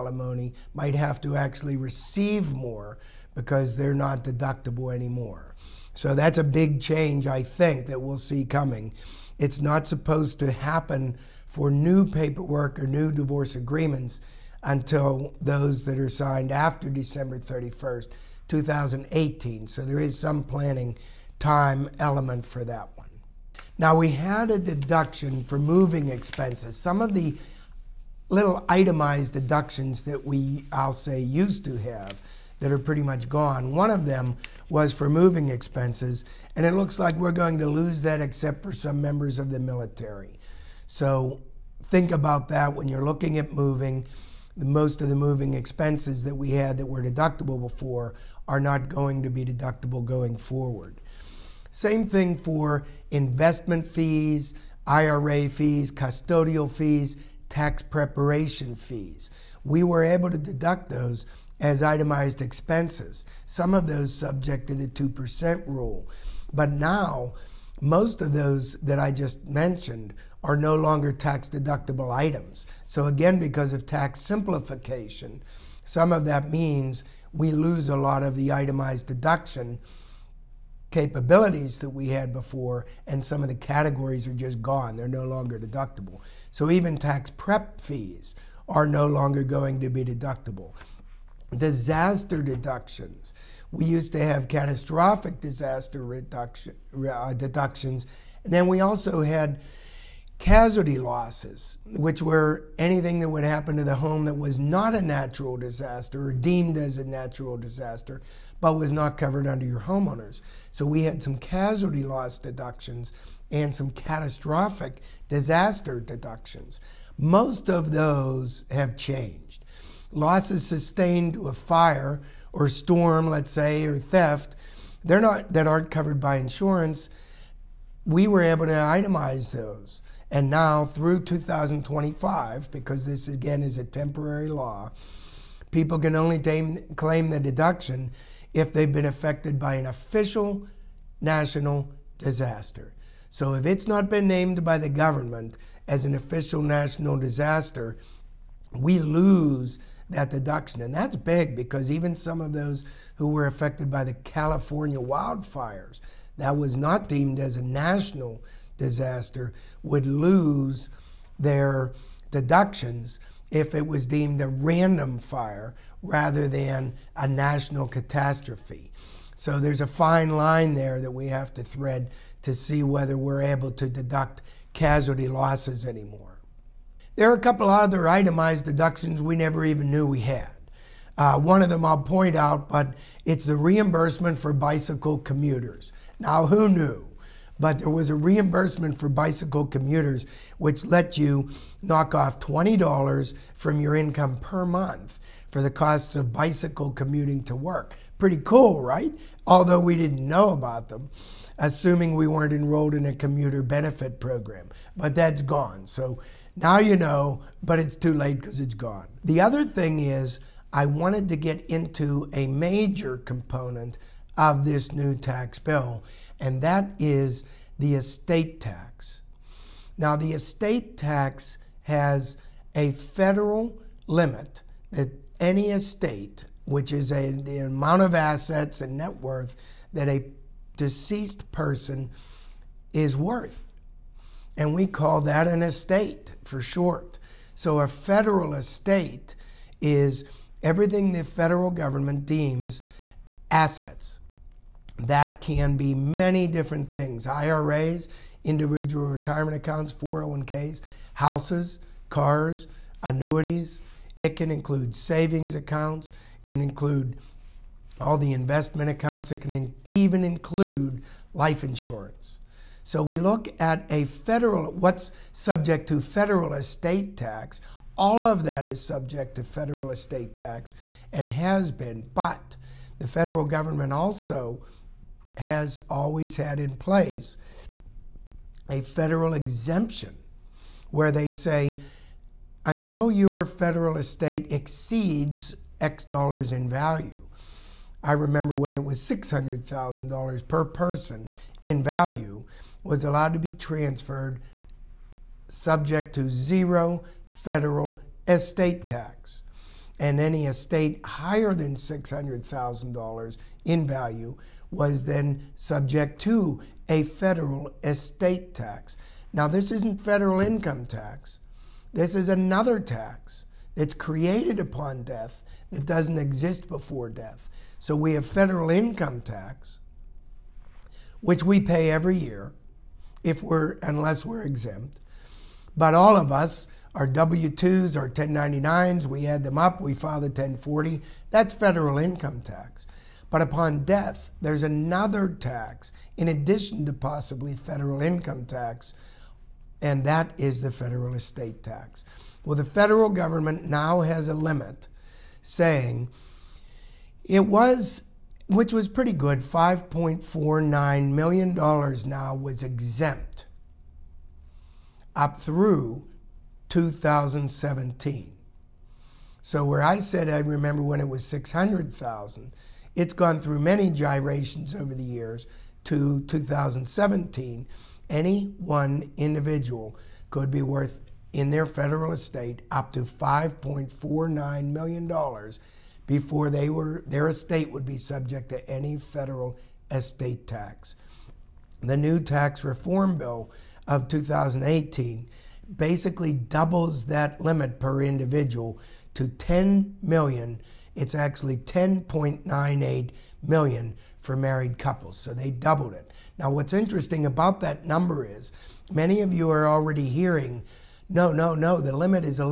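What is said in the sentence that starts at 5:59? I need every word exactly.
So where I said I remember when it was 600,000, it's gone through many gyrations over the years to 2017.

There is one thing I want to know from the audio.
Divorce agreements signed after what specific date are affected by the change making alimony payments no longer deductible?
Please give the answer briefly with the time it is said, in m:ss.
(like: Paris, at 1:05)
December 31st, 2018, at 0:16.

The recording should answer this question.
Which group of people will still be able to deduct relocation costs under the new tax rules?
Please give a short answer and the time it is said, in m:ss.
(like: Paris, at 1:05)
members of the military, at 0:39.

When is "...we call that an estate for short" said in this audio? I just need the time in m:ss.
3:54.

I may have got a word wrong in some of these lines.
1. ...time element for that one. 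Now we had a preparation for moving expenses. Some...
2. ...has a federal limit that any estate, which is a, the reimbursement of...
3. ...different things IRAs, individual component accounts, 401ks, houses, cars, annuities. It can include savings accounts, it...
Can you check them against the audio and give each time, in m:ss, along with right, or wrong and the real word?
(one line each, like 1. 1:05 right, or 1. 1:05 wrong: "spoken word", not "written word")
1. 0:21 wrong: "deduction", not "preparation"
2. 3:41 wrong: "amount", not "reimbursement"
3. 4:06 wrong: "retirement", not "component".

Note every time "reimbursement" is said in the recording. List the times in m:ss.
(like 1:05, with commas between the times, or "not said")
3:03, 3:08.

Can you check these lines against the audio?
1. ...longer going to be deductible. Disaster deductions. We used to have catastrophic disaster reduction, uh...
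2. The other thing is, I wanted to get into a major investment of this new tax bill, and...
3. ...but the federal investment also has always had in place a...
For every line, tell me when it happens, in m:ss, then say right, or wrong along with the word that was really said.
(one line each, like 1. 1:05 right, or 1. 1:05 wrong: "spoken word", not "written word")
1. 1:29 right
2. 3:29 wrong: "component", not "investment"
3. 4:32 wrong: "government", not "investment".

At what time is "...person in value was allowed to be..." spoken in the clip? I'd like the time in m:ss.
4:50.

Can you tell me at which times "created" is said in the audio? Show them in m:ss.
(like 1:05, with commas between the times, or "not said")
5:13.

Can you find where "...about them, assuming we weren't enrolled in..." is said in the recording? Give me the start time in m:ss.
3:20.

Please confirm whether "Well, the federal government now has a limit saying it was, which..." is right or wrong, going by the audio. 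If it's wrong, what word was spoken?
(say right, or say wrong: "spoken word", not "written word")
right.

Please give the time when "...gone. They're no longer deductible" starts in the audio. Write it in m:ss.
1:24.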